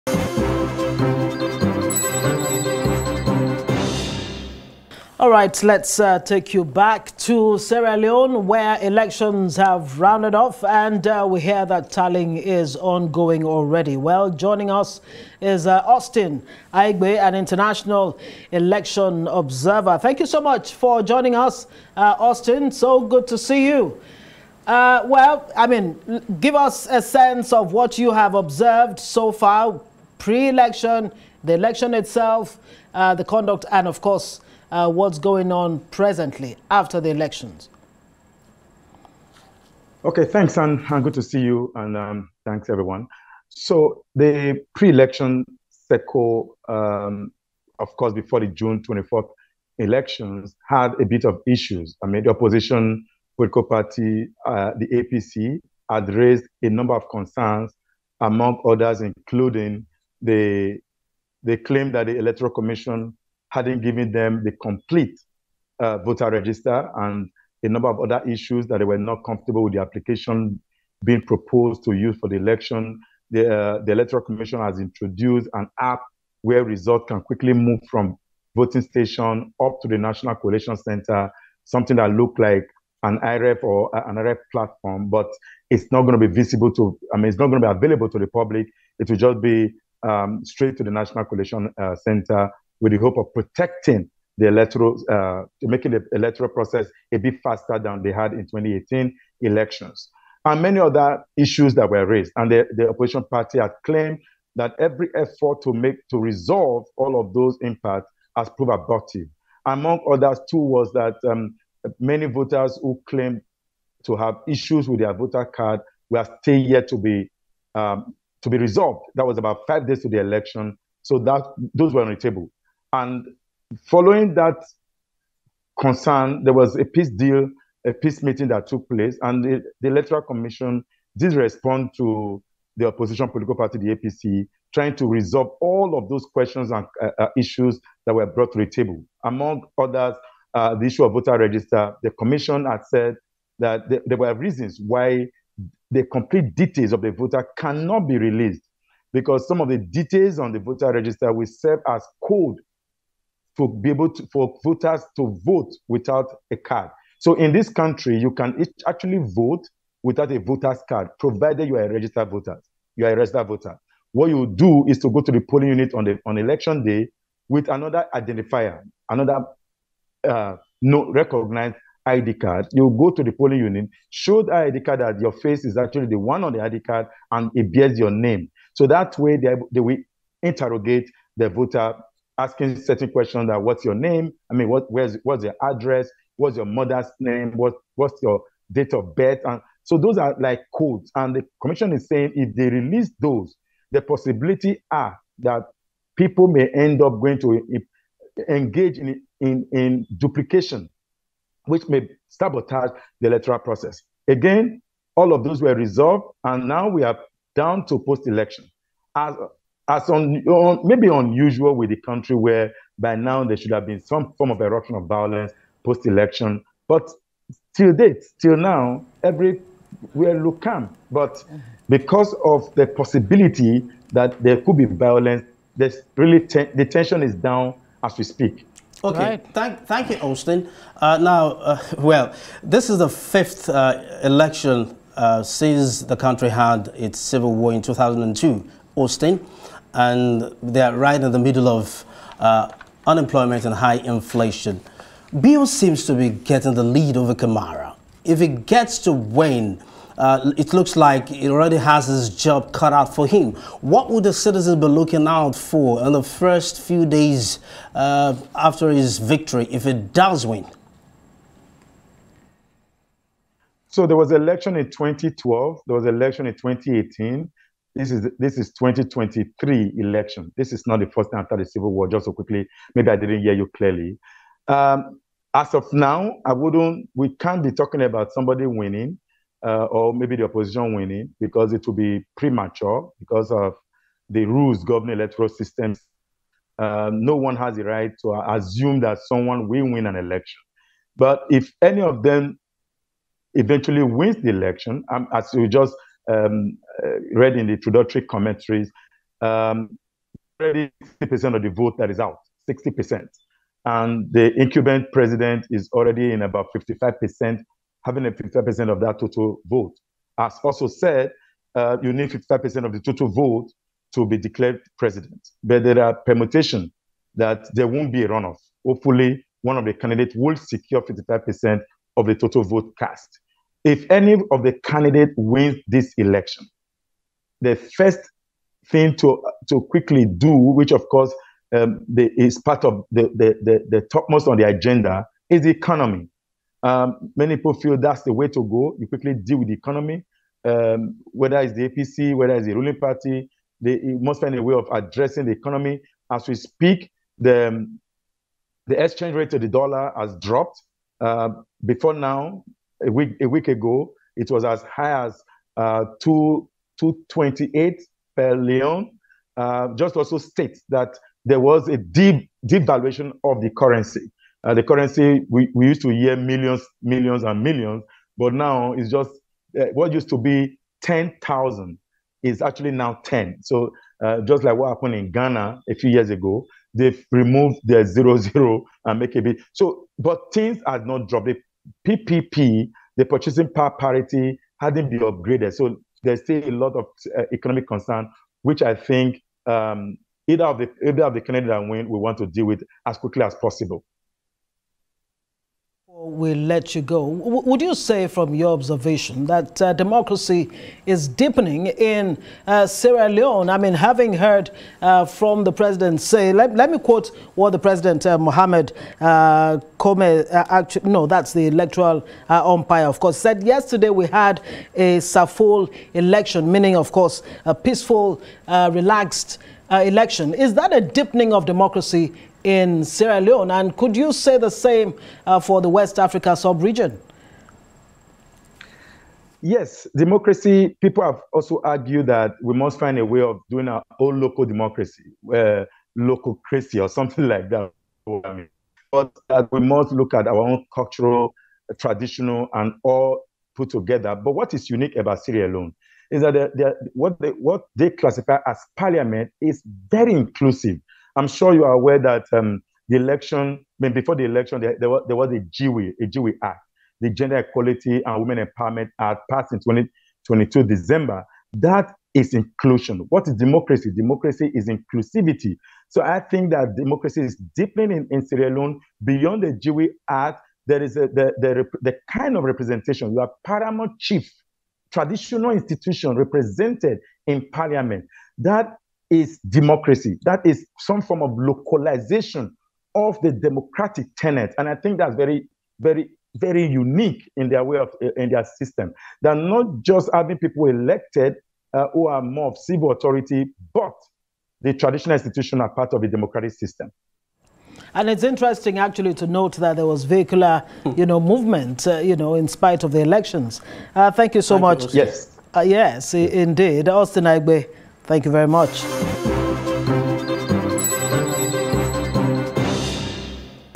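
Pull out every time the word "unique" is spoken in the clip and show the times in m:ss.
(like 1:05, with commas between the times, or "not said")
7:24, 8:06.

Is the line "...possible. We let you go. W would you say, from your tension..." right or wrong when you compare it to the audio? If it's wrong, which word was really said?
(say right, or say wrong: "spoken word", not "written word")
wrong: "observation", not "tension".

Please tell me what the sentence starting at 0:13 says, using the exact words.
Well, joining us is uh, Austin Aigbe, an international election observer.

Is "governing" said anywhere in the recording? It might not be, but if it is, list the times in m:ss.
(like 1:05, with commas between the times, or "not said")
4:44.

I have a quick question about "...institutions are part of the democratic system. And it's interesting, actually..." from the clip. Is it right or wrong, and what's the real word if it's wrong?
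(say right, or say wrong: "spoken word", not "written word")
right.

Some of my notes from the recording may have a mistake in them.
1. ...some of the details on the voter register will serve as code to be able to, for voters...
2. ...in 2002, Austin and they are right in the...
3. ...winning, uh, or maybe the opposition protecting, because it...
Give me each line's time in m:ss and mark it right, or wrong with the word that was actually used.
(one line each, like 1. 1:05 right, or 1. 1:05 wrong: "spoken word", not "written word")
1. 2:29 right
2. 3:57 right
3. 4:38 wrong: "winning", not "protecting".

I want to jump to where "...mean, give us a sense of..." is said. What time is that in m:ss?
0:25.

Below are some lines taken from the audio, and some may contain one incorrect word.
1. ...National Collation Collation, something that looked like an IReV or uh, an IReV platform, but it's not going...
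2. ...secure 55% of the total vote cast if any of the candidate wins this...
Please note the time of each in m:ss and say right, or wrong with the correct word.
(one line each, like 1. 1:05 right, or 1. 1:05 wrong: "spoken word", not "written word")
1. 1:19 wrong: "Center", not "Collation"
2. 5:20 right.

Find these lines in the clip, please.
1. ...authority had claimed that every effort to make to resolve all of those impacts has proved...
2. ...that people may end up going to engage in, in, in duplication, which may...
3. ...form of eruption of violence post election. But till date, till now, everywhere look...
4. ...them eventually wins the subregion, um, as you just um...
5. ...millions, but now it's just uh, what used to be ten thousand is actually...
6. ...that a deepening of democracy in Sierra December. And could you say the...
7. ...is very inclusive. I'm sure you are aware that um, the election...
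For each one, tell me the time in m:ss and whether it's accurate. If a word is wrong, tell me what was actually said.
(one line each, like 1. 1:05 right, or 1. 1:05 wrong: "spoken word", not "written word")
1. 1:43 wrong: "party", not "authority"
2. 3:15 right
3. 3:34 right
4. 4:52 wrong: "election", not "subregion"
5. 6:07 right
6. 7:00 wrong: "Leone", not "December"
7. 7:29 right.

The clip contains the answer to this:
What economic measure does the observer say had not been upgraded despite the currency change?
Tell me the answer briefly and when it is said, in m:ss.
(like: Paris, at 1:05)
purchasing power parity, at 6:23.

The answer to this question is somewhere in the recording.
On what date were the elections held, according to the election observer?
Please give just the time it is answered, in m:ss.
0:48.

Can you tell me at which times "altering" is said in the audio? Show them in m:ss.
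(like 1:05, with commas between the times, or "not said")
not said.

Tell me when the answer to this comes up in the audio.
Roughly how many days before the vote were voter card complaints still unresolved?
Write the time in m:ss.
1:59.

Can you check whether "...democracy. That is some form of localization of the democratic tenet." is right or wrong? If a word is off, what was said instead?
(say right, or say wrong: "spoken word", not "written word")
right.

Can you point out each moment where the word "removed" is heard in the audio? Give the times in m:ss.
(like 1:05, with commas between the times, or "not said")
6:17.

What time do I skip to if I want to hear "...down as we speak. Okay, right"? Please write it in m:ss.
3:47.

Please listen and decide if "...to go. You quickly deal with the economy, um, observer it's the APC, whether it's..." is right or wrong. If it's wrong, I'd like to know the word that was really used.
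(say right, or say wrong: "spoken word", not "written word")
wrong: "whether", not "observer".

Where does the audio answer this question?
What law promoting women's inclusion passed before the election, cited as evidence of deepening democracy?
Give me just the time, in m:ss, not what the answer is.
7:37.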